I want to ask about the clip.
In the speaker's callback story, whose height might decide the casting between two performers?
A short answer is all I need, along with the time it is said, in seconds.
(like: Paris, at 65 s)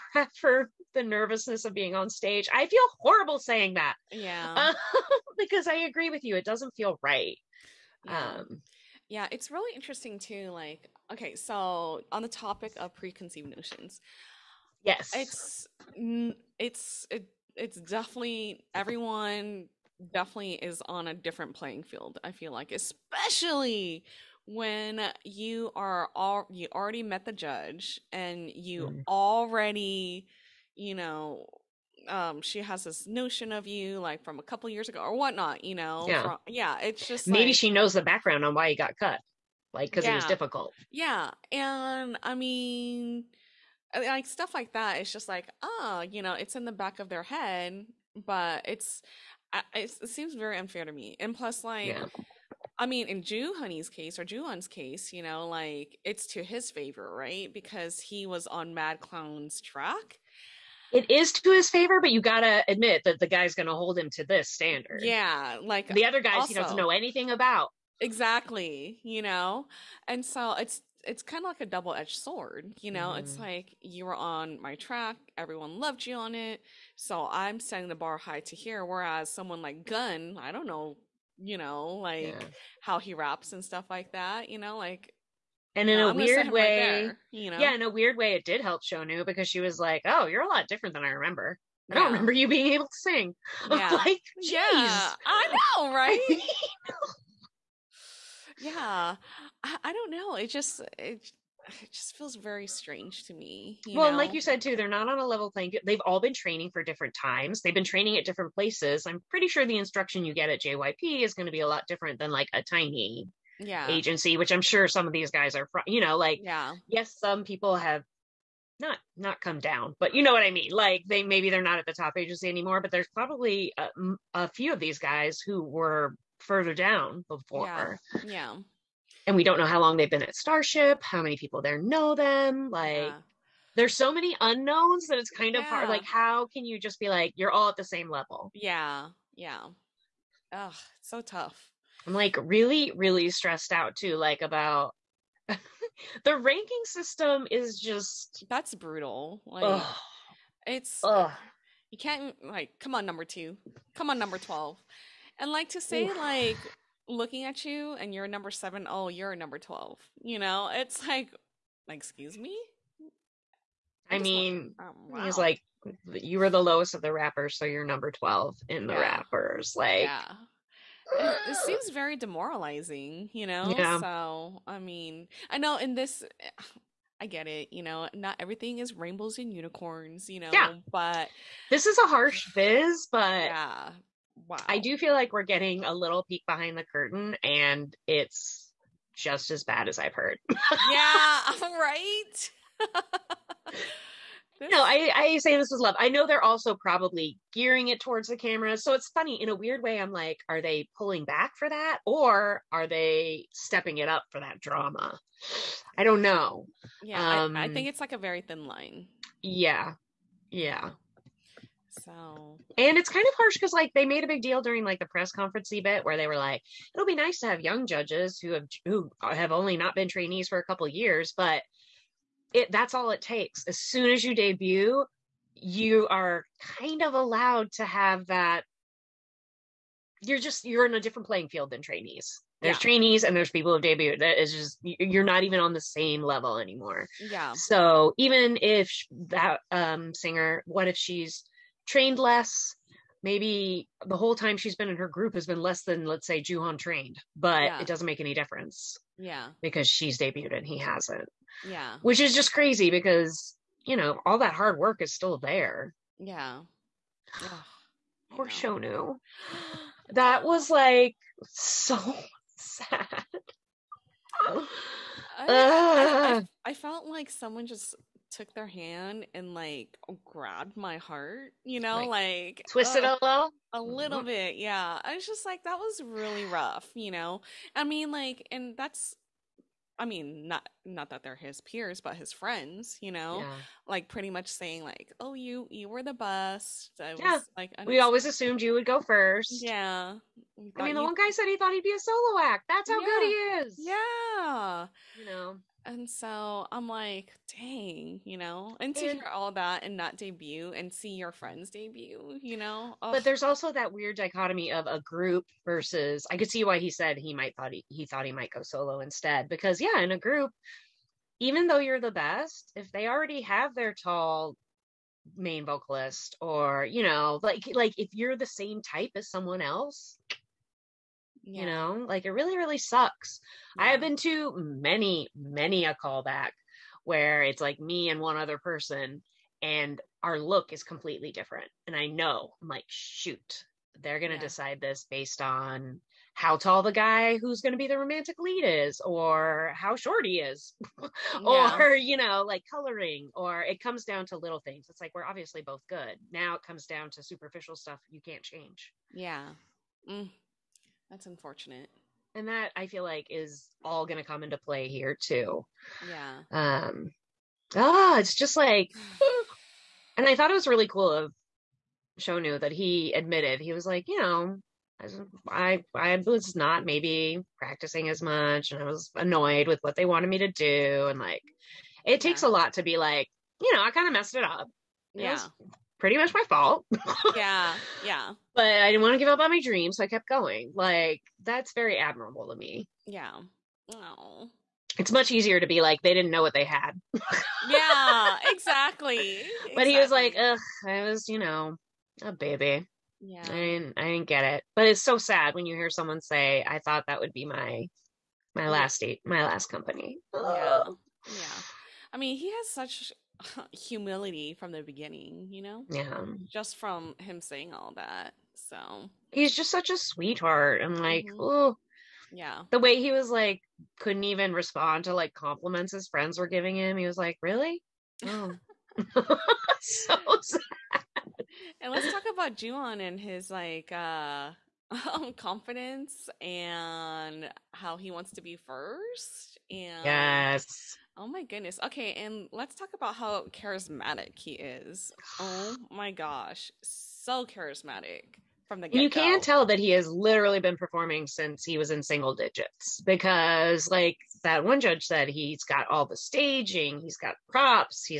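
The romantic lead, at 337 s.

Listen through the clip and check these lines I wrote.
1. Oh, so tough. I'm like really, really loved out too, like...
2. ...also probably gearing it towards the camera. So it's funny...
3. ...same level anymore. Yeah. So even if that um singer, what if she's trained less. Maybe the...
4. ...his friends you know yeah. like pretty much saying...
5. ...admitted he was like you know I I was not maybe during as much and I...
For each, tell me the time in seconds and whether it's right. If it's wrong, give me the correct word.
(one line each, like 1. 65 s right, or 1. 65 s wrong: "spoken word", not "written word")
1. 140 s wrong: "stressed", not "loved"
2. 196 s right
3. 235 s right
4. 282 s right
5. 363 s wrong: "practicing", not "during".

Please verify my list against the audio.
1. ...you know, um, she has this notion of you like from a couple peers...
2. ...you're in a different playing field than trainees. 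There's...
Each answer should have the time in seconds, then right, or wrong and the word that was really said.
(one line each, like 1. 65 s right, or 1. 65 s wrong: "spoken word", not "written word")
1. 30 s wrong: "years", not "peers"
2. 230 s right.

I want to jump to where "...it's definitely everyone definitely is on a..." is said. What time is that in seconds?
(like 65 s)
17 s.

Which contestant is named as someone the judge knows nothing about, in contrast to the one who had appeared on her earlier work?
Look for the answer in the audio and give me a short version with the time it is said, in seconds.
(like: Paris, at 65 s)
Gunn, at 79 s.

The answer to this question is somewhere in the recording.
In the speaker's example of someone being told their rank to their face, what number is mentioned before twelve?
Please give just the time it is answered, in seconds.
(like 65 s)
158 s.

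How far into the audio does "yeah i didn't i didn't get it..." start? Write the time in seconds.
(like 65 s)
393 s.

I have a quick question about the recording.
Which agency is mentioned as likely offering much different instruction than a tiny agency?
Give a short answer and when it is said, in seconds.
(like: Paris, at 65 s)
JYP, at 110 s.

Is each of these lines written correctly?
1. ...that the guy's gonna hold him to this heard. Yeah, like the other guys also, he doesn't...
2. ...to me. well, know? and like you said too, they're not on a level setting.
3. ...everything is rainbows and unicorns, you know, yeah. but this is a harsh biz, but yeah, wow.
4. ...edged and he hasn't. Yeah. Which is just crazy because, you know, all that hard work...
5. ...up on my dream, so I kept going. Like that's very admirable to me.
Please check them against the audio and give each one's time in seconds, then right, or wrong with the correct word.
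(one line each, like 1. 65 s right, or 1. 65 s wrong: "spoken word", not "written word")
1. 63 s wrong: "standard", not "heard"
2. 103 s wrong: "playing", not "setting"
3. 178 s right
4. 250 s wrong: "debuted", not "edged"
5. 379 s right.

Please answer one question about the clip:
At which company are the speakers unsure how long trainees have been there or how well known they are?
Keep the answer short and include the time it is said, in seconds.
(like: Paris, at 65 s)
Starship, at 130 s.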